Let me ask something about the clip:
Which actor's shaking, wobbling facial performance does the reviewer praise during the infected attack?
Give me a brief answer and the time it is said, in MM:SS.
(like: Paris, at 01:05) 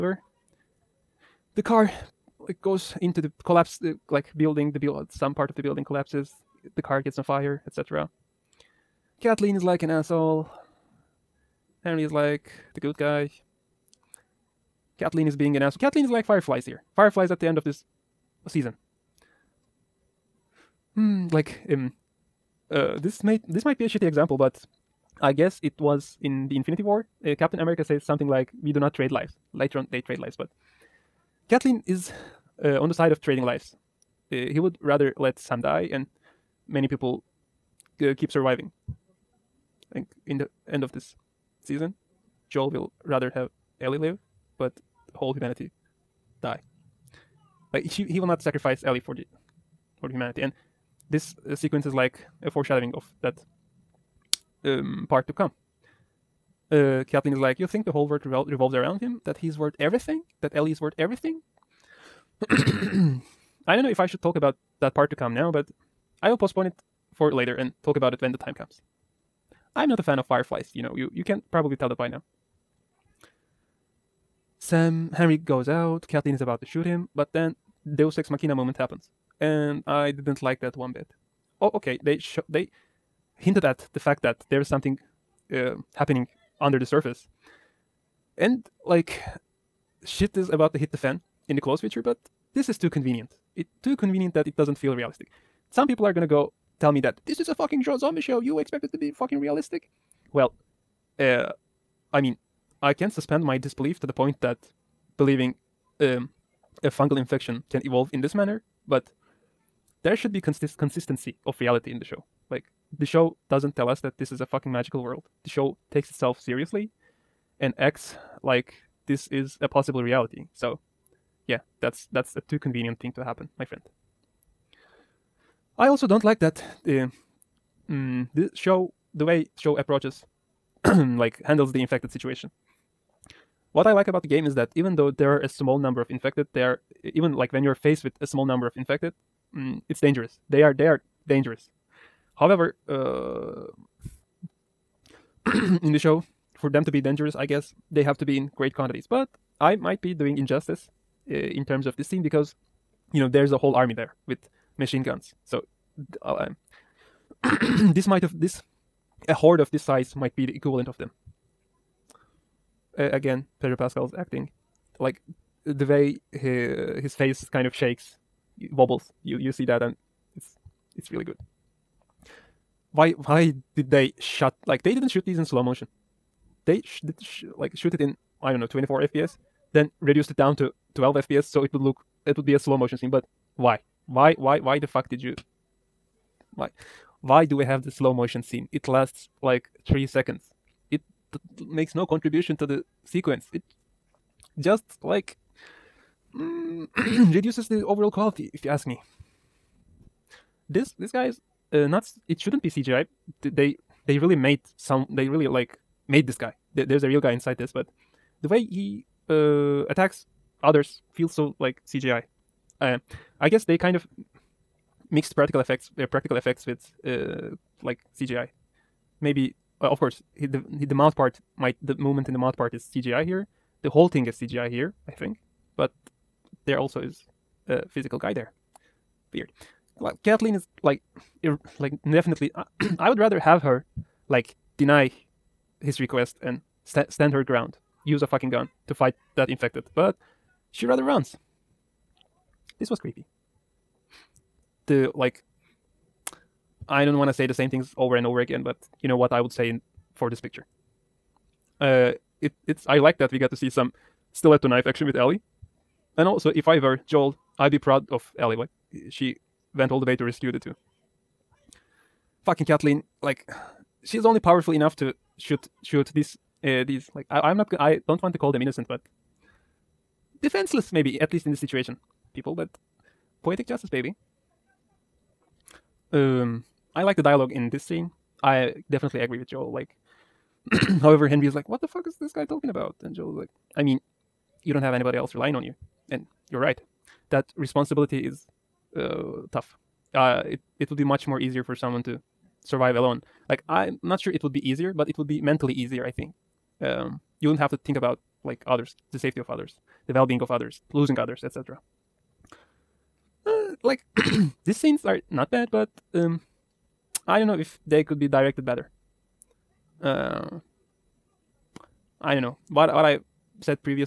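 Pedro Pascal, at 02:43.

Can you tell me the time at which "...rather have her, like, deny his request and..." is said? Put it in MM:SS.
03:53.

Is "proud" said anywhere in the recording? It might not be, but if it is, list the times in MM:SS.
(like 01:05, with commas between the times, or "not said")
04:17.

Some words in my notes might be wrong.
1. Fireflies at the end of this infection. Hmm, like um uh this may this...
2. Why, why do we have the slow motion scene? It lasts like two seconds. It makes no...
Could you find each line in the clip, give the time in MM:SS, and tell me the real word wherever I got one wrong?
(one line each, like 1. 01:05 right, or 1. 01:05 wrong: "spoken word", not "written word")
1. 00:16 wrong: "season", not "infection"
2. 03:06 wrong: "three", not "two".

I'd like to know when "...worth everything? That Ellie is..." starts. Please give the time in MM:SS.
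00:59.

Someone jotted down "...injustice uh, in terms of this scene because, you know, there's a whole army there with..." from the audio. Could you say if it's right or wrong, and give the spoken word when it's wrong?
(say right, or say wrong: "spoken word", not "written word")
right.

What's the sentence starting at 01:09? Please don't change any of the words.
I'm not a fan of fireflies, you know, you, you can probably tell that by now.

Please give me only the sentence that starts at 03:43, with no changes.
The whole thing is CGI here, I think.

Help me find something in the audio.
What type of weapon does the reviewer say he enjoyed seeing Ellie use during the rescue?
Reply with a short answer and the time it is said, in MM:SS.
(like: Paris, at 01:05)
stiletto knife, at 04:14.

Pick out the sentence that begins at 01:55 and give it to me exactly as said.
The show takes itself seriously and acts like this is a possible reality.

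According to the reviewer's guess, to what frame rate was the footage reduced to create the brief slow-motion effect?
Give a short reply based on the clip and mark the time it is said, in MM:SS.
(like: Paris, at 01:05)
12 FPS, at 03:00.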